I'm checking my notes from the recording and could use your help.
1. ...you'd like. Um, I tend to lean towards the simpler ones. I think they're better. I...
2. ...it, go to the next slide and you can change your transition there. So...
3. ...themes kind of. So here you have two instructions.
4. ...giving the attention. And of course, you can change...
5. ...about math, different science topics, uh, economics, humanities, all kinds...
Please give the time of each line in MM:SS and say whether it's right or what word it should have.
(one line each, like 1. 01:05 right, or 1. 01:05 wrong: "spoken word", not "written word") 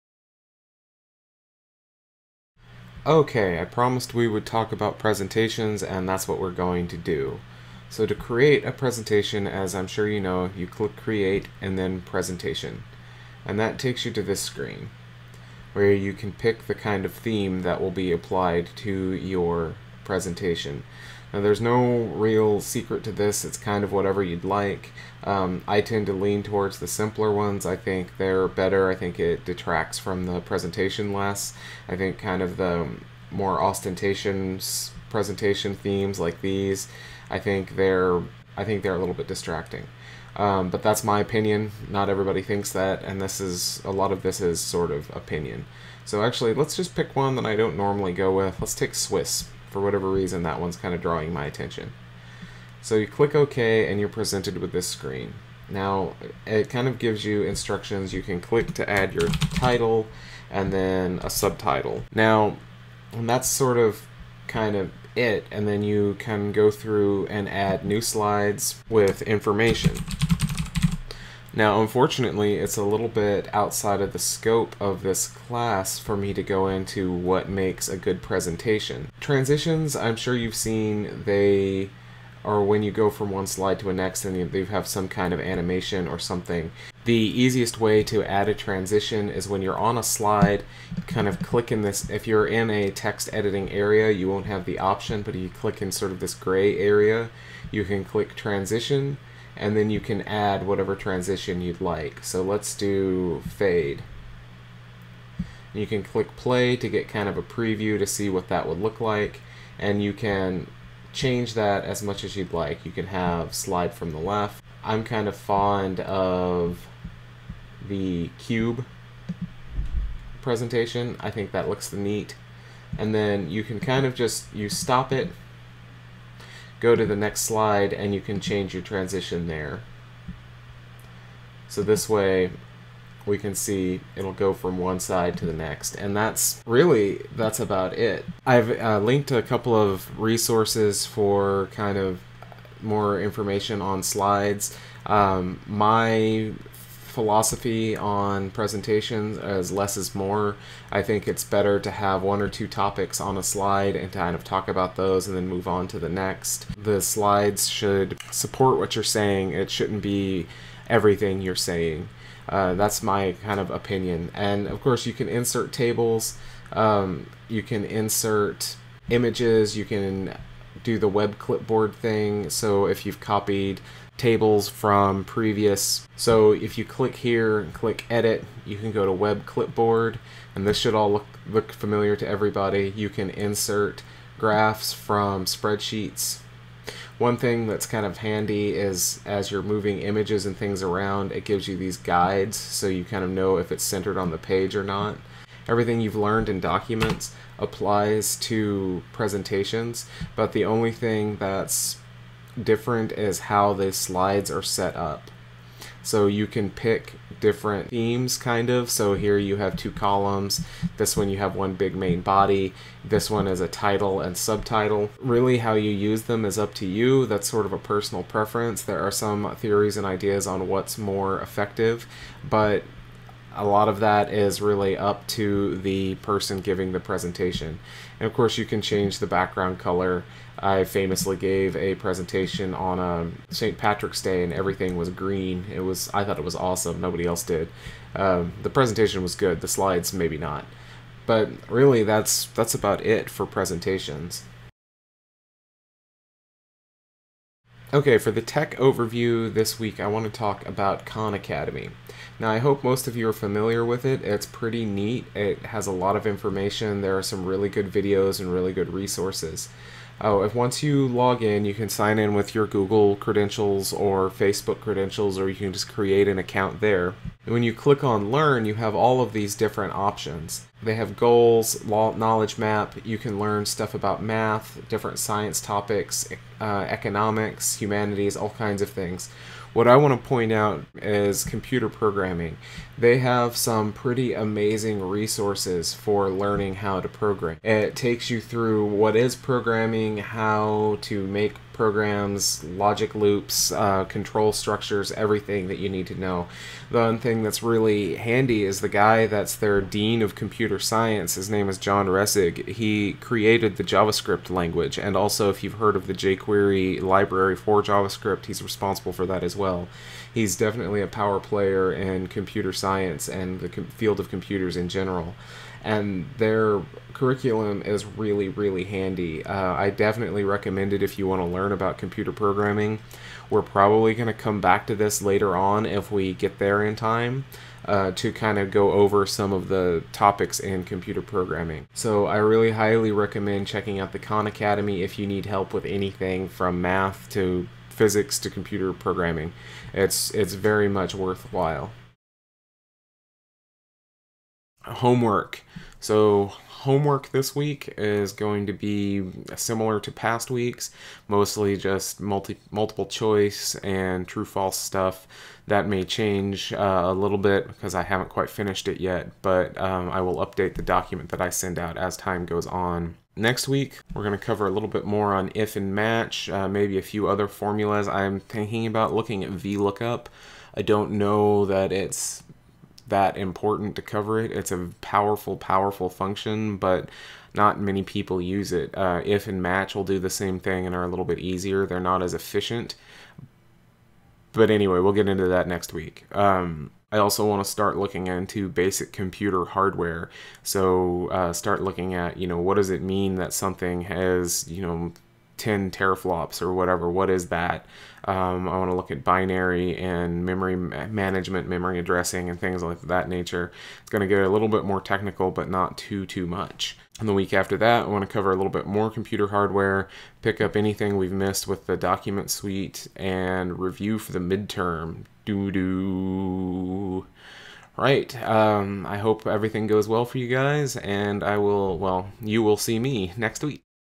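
1. 00:24 right
2. 02:05 right
3. 03:27 wrong: "columns", not "instructions"
4. 03:46 wrong: "presentation", not "attention"
5. 04:33 right.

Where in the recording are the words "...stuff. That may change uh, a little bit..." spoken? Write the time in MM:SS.
05:54.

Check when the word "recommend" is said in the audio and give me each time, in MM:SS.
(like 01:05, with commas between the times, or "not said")
05:20, 05:33.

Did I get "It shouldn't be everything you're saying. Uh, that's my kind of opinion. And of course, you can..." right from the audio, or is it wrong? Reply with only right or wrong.
right.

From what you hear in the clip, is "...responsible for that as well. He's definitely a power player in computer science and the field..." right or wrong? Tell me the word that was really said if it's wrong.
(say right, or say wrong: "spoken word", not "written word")
right.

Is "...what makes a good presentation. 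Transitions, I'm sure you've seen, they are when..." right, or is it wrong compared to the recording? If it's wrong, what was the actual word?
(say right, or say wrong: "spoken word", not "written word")
right.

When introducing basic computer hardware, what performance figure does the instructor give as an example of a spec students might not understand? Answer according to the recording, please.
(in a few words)
10 teraflops.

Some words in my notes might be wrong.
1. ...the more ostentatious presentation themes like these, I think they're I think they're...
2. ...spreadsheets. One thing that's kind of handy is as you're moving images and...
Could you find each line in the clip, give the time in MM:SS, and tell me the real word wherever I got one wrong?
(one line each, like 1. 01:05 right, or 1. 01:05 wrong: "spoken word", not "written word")
1. 00:32 right
2. 03:05 right.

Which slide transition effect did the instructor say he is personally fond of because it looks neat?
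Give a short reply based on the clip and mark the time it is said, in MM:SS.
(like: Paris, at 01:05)
Cube, at 01:58.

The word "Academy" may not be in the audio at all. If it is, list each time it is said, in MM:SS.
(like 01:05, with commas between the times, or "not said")
04:11, 05:34.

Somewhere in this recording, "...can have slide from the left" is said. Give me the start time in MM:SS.
01:52.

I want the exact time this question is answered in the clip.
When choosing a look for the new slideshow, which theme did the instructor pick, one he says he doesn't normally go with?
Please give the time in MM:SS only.
00:48.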